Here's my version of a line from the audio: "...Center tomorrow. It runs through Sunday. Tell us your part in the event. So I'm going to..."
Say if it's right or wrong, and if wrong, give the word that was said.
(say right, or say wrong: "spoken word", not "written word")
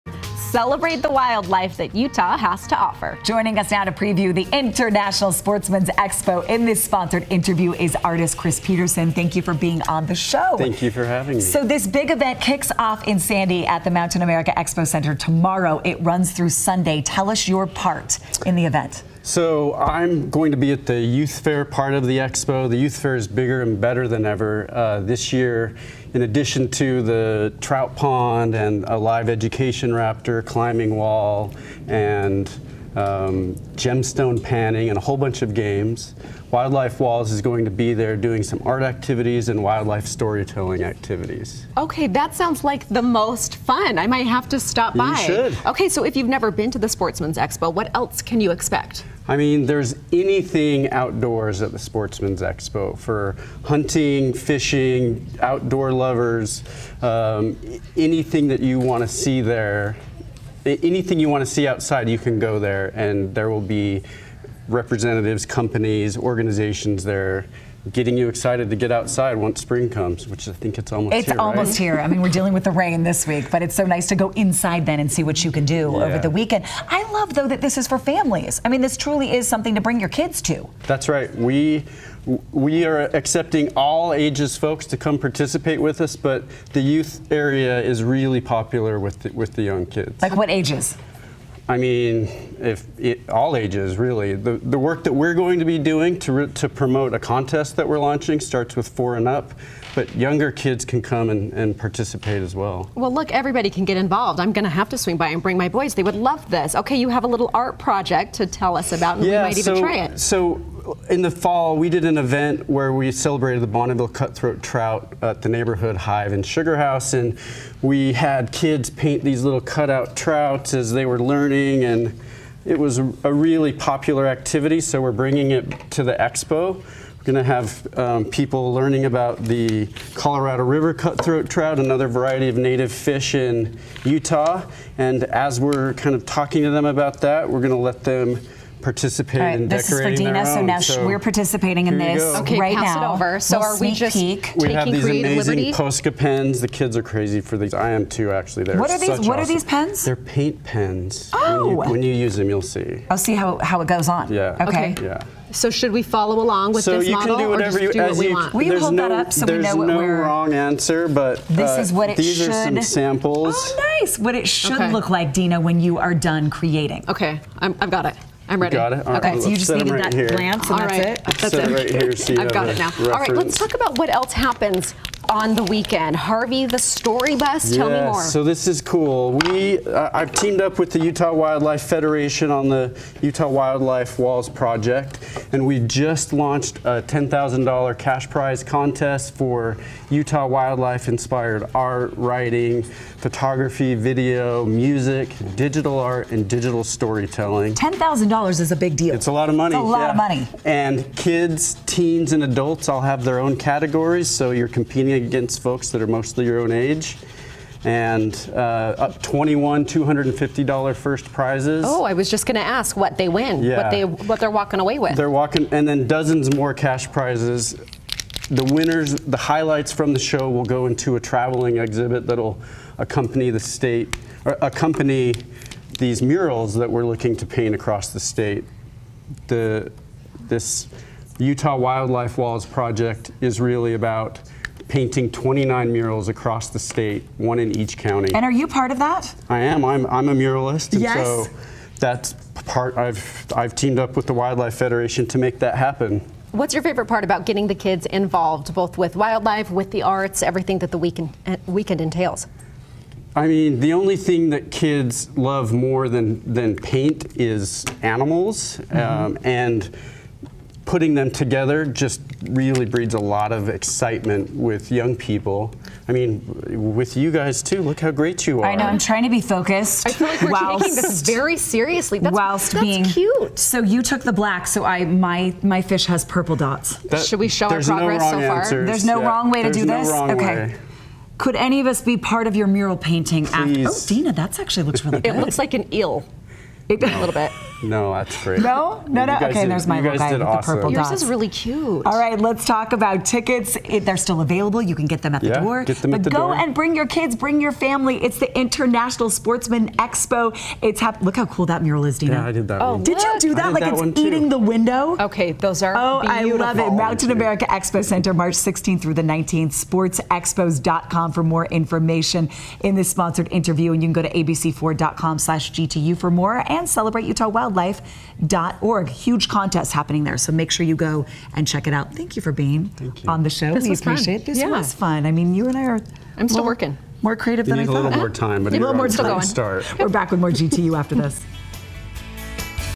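right.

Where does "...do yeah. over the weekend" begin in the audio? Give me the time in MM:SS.
01:15.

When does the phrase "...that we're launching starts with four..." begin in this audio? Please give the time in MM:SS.
01:37.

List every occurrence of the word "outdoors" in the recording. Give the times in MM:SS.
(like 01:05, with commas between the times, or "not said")
00:50, 00:55.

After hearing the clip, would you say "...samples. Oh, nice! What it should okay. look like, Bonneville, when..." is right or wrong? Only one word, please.
wrong.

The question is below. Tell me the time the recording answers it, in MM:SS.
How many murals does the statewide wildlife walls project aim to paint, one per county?
03:55.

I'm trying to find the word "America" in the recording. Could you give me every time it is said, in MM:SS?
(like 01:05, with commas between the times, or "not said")
00:14, 05:07.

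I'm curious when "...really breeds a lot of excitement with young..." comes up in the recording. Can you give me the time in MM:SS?
04:22.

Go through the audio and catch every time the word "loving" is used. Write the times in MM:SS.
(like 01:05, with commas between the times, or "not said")
not said.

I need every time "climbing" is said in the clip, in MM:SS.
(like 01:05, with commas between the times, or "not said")
00:30.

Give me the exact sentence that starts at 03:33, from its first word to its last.
what, they, what they're walking away with.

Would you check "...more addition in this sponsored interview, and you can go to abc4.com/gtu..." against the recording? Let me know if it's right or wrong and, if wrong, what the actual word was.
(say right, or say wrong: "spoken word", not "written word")
wrong: "information", not "addition".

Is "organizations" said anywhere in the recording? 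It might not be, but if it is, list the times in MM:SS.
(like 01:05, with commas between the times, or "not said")
01:06.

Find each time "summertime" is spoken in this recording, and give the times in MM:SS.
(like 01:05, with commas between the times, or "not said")
not said.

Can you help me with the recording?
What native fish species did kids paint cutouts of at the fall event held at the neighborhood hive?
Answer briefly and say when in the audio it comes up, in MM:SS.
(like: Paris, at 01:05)
Bonneville cutthroat trout, at 01:53.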